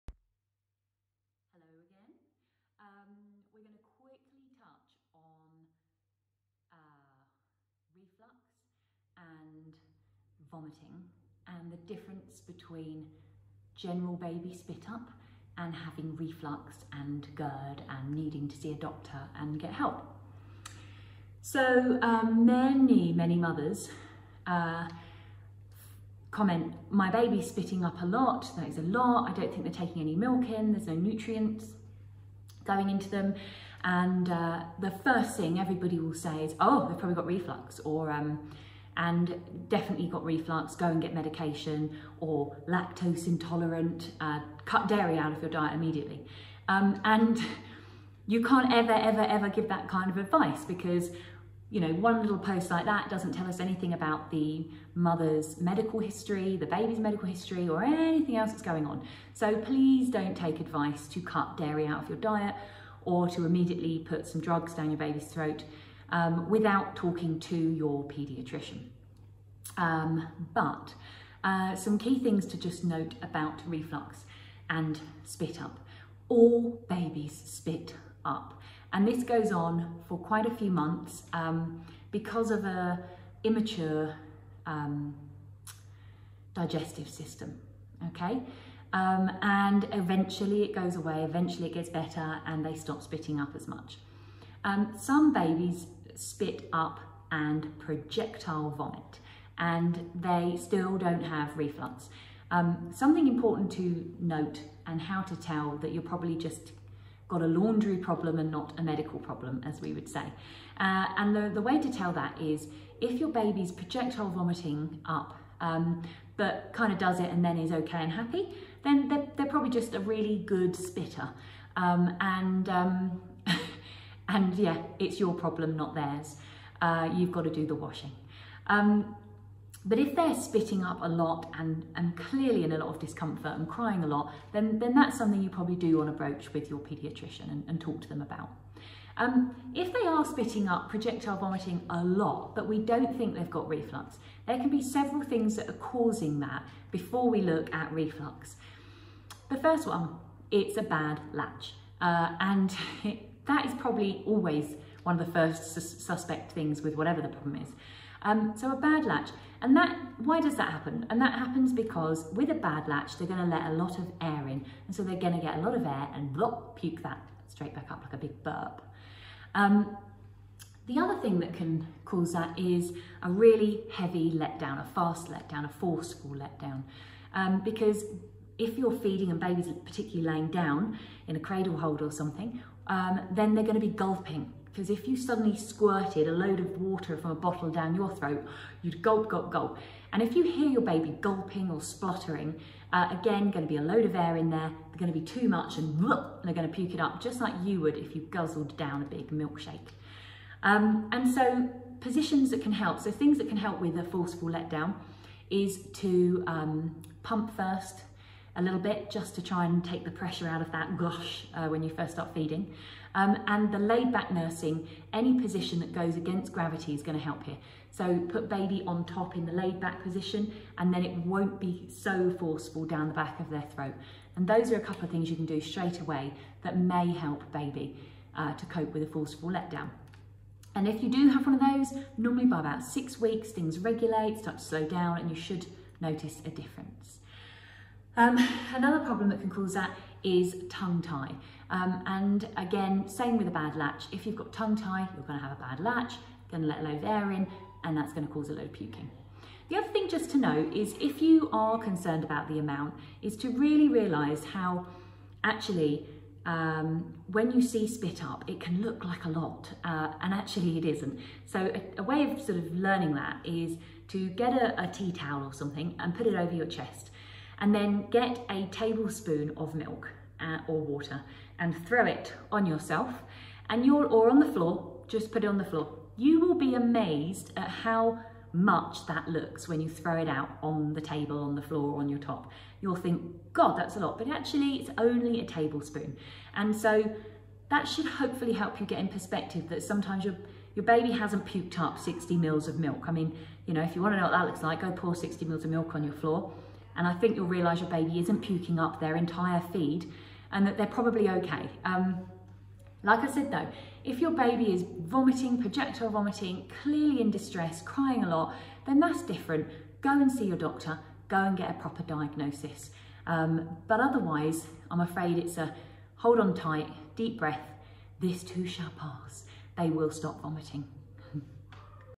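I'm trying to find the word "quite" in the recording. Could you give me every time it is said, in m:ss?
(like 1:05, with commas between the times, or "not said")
1:20.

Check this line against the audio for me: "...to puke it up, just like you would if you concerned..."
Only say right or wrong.
wrong.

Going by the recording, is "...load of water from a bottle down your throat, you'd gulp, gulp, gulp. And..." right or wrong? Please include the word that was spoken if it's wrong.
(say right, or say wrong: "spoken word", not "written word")
right.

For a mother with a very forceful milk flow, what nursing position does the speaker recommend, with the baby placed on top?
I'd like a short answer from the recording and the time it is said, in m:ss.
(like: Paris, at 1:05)
Laid back nursing, at 3:33.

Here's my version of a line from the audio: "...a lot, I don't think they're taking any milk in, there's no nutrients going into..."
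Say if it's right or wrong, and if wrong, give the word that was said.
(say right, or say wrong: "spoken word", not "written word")
right.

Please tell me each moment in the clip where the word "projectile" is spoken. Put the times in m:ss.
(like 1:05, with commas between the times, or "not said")
1:37, 1:53, 2:20, 5:05.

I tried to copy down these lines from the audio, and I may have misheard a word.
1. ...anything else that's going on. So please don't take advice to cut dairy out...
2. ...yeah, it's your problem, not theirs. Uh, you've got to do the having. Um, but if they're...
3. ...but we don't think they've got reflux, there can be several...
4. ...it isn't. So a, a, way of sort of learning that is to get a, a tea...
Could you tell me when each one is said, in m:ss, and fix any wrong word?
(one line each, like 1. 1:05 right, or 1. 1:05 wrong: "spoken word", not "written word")
1. 0:57 right
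2. 2:04 wrong: "washing", not "having"
3. 2:22 right
4. 4:20 right.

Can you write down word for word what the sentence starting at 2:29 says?
The first one, it's a bad latch.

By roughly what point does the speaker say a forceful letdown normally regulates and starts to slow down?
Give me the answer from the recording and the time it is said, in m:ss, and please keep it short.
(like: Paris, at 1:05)
About 6 weeks, at 3:52.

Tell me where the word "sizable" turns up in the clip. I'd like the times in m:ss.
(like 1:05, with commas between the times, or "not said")
not said.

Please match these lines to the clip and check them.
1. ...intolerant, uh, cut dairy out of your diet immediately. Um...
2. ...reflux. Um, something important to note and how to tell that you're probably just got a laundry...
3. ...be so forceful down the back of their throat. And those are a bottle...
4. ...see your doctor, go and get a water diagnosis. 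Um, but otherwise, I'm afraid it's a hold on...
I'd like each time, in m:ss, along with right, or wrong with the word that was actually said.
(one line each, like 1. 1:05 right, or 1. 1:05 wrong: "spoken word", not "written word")
1. 0:43 right
2. 1:41 right
3. 3:41 wrong: "couple", not "bottle"
4. 5:10 wrong: "proper", not "water".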